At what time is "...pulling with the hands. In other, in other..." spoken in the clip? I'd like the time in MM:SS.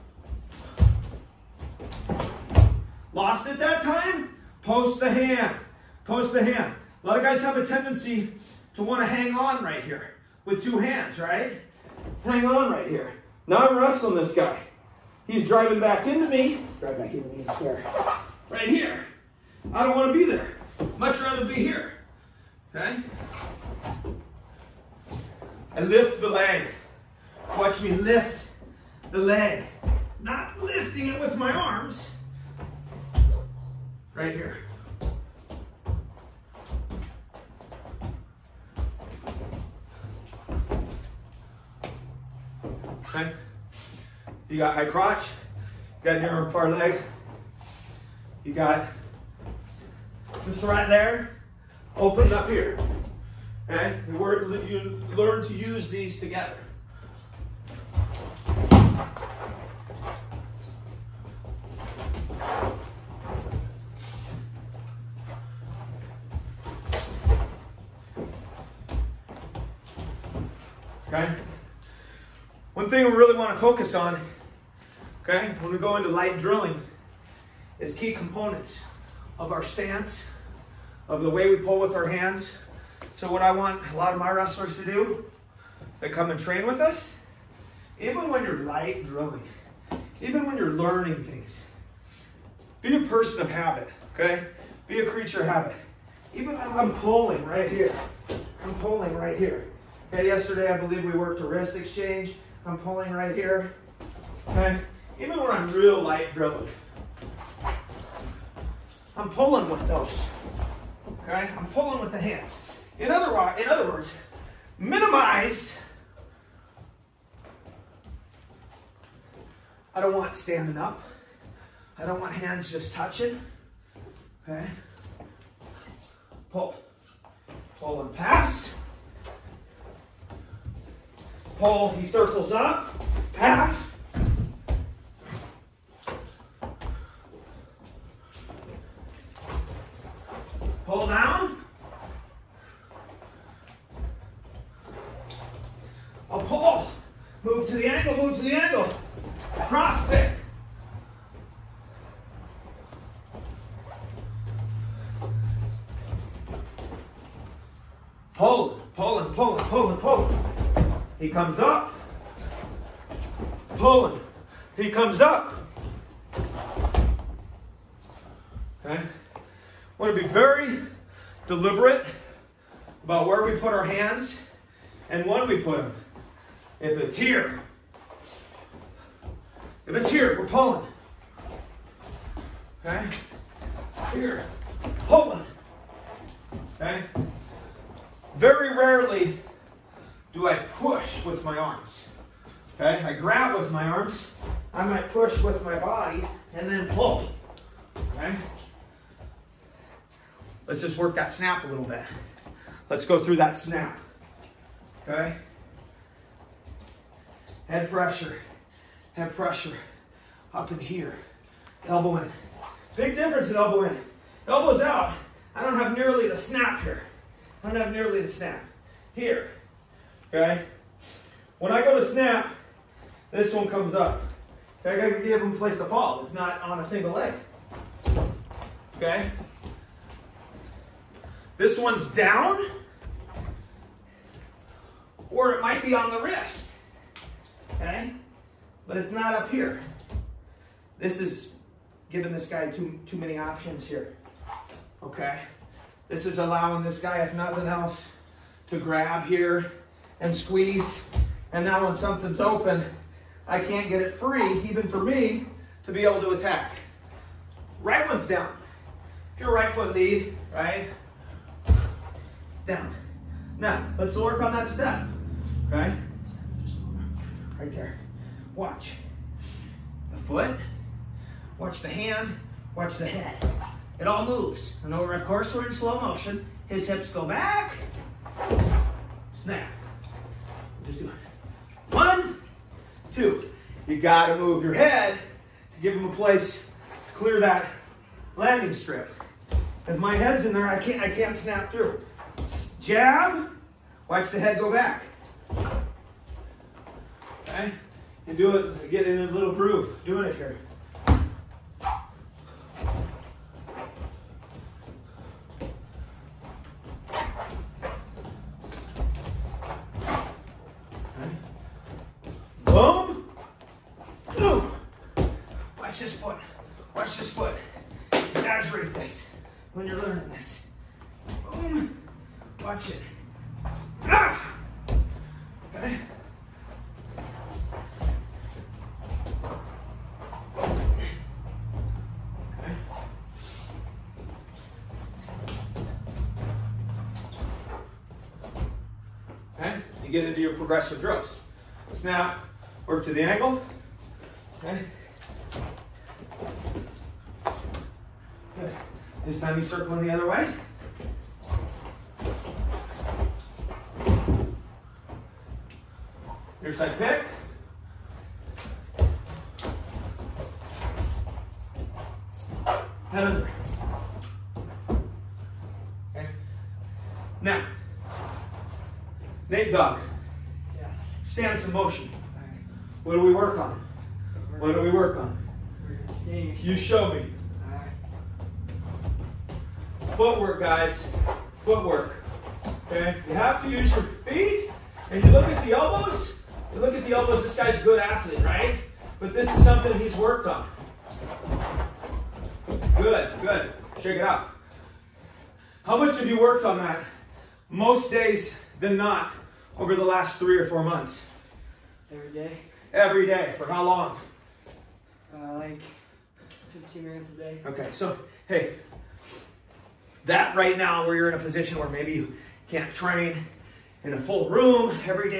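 01:51.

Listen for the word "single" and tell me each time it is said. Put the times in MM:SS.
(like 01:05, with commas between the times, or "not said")
03:46.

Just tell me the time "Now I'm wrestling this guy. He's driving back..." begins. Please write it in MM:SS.
00:13.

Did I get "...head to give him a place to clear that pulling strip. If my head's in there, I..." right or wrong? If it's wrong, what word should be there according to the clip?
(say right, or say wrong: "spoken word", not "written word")
wrong: "landing", not "pulling".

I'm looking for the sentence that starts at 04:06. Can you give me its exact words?
This is allowing this guy, if nothing else, to grab here and squeeze.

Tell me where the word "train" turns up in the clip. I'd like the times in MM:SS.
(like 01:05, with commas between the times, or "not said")
01:26, 06:52.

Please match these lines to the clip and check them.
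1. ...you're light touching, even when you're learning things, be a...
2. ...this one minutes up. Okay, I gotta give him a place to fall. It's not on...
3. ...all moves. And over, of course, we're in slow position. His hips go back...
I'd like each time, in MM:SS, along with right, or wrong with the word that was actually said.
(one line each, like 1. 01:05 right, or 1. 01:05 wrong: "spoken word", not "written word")
1. 01:28 wrong: "drilling", not "touching"
2. 03:43 wrong: "comes", not "minutes"
3. 04:34 wrong: "motion", not "position".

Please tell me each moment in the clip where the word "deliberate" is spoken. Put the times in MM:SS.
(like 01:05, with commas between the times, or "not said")
02:51.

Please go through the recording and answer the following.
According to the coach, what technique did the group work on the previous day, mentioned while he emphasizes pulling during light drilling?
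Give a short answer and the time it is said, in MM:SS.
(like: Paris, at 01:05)
wrist exchange, at 01:41.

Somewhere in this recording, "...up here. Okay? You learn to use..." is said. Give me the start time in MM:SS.
00:52.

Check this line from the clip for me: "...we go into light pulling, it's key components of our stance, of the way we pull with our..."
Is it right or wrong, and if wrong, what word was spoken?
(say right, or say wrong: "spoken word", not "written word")
wrong: "drilling", not "pulling".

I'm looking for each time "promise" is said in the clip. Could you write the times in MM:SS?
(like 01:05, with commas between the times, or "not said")
not said.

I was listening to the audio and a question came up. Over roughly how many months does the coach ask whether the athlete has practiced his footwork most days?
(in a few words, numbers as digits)
3 or 4.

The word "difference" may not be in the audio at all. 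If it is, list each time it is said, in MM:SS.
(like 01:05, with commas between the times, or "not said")
03:33.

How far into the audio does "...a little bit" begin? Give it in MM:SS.
03:21.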